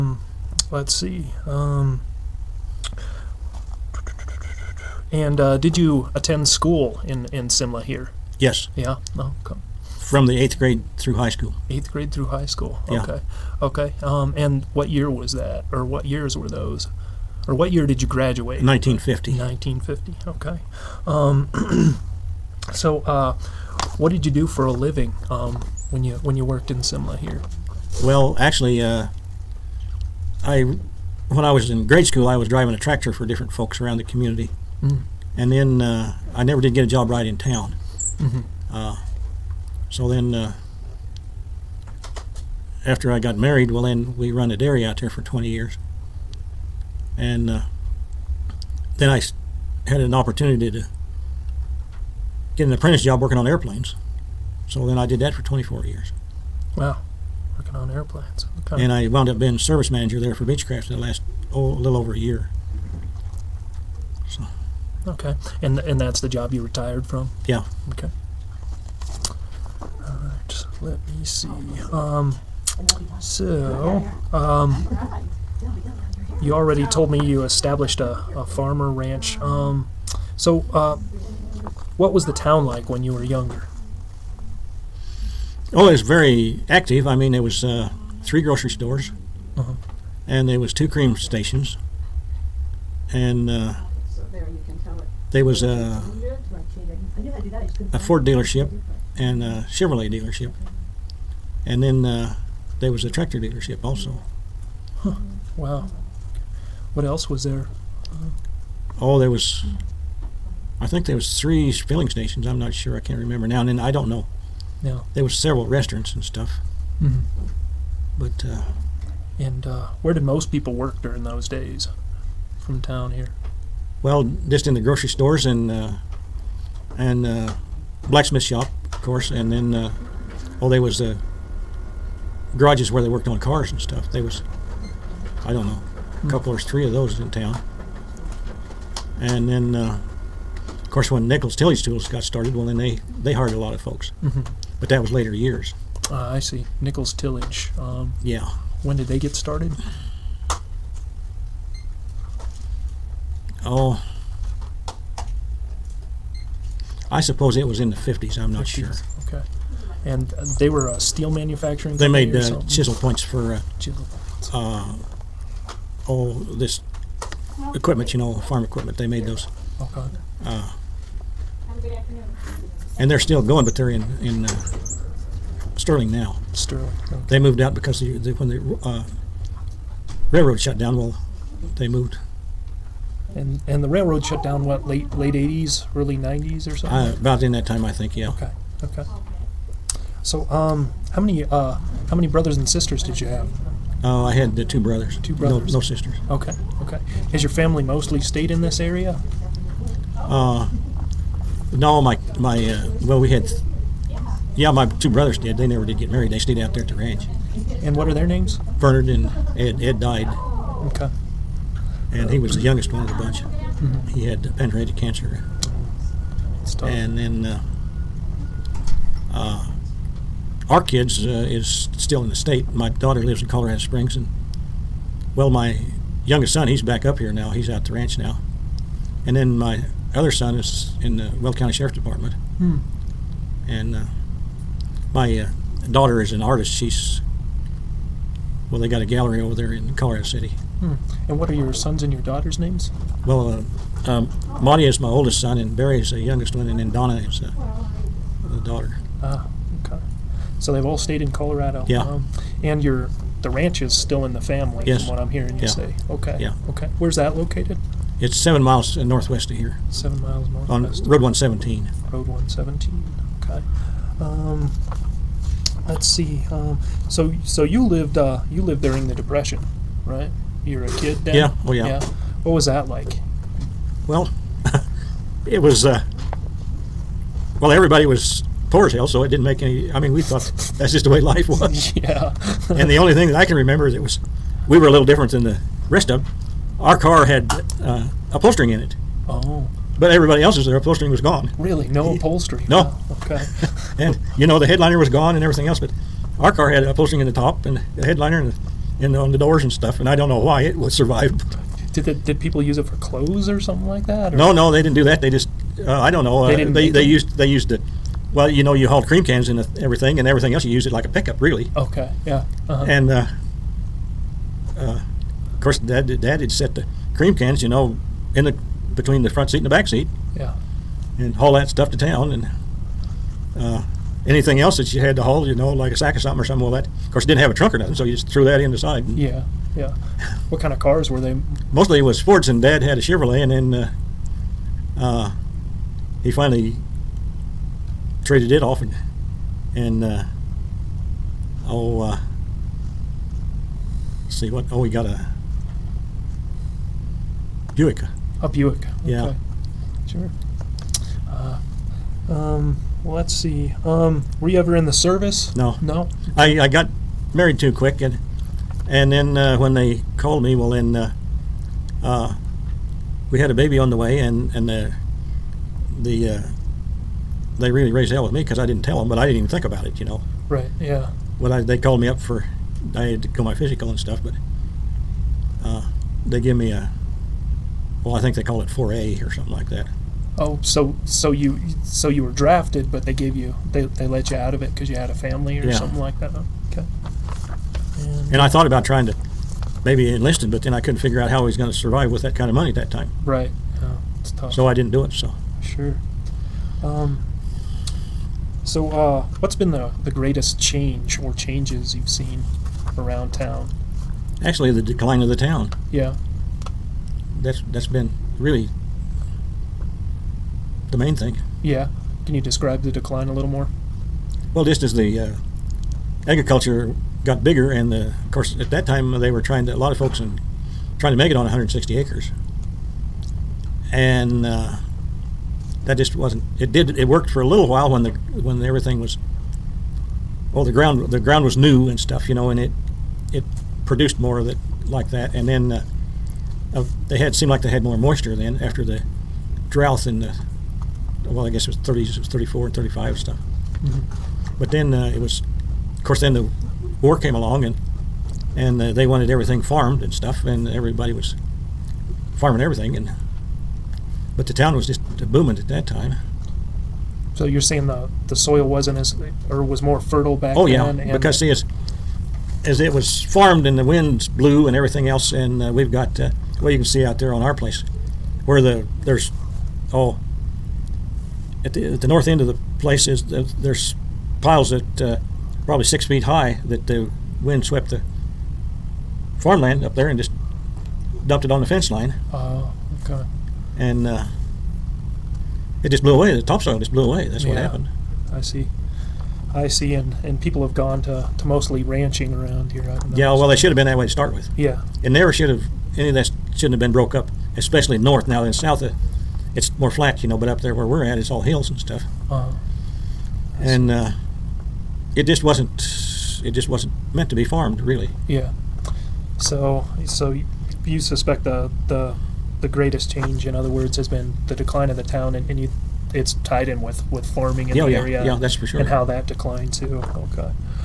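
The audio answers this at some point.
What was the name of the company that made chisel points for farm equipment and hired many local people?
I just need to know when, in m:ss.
2:21.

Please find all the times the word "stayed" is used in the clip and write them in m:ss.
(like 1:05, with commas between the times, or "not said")
3:18, 3:26, 4:10.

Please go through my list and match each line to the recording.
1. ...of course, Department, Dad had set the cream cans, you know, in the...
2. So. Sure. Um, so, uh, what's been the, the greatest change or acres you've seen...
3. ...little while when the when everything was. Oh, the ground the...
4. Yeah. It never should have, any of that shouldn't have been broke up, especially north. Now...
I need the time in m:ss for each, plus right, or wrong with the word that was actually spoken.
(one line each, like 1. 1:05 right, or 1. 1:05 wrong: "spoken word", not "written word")
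1. 5:15 wrong: "Dad", not "Department"
2. 6:35 wrong: "changes", not "acres"
3. 7:07 right
4. 8:14 right.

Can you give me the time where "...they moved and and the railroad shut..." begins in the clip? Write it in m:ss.
3:01.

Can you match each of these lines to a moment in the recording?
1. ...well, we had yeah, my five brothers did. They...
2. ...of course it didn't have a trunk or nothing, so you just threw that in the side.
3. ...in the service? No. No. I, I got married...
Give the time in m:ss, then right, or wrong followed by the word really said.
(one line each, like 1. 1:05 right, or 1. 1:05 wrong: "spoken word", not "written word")
1. 3:23 wrong: "two", not "five"
2. 5:26 right
3. 5:54 right.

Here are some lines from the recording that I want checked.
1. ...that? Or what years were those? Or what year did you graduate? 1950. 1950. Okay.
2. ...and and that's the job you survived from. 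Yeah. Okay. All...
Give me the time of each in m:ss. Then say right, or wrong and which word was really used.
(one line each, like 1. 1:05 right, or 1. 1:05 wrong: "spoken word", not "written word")
1. 0:15 right
2. 1:05 wrong: "retired", not "survived".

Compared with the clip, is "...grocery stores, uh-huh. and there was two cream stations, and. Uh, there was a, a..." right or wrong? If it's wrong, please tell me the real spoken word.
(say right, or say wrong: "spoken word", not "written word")
right.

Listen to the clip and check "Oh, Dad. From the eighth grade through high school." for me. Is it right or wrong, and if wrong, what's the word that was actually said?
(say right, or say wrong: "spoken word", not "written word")
wrong: "Okay", not "Dad".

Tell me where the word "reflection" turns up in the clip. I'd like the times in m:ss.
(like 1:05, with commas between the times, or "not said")
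not said.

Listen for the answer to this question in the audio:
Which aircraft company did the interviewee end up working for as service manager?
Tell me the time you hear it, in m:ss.
1:00.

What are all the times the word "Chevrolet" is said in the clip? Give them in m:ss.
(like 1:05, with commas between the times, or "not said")
1:39, 5:32.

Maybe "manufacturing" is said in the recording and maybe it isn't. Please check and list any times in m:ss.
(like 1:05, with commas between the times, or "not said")
2:41.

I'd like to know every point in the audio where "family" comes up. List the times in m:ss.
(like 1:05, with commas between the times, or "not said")
3:17, 4:14, 6:25.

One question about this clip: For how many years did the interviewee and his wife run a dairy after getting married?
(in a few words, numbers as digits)
20 years.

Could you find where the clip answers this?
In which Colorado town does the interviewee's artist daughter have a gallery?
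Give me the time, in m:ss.
3:59.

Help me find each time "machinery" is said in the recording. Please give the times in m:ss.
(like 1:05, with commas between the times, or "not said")
not said.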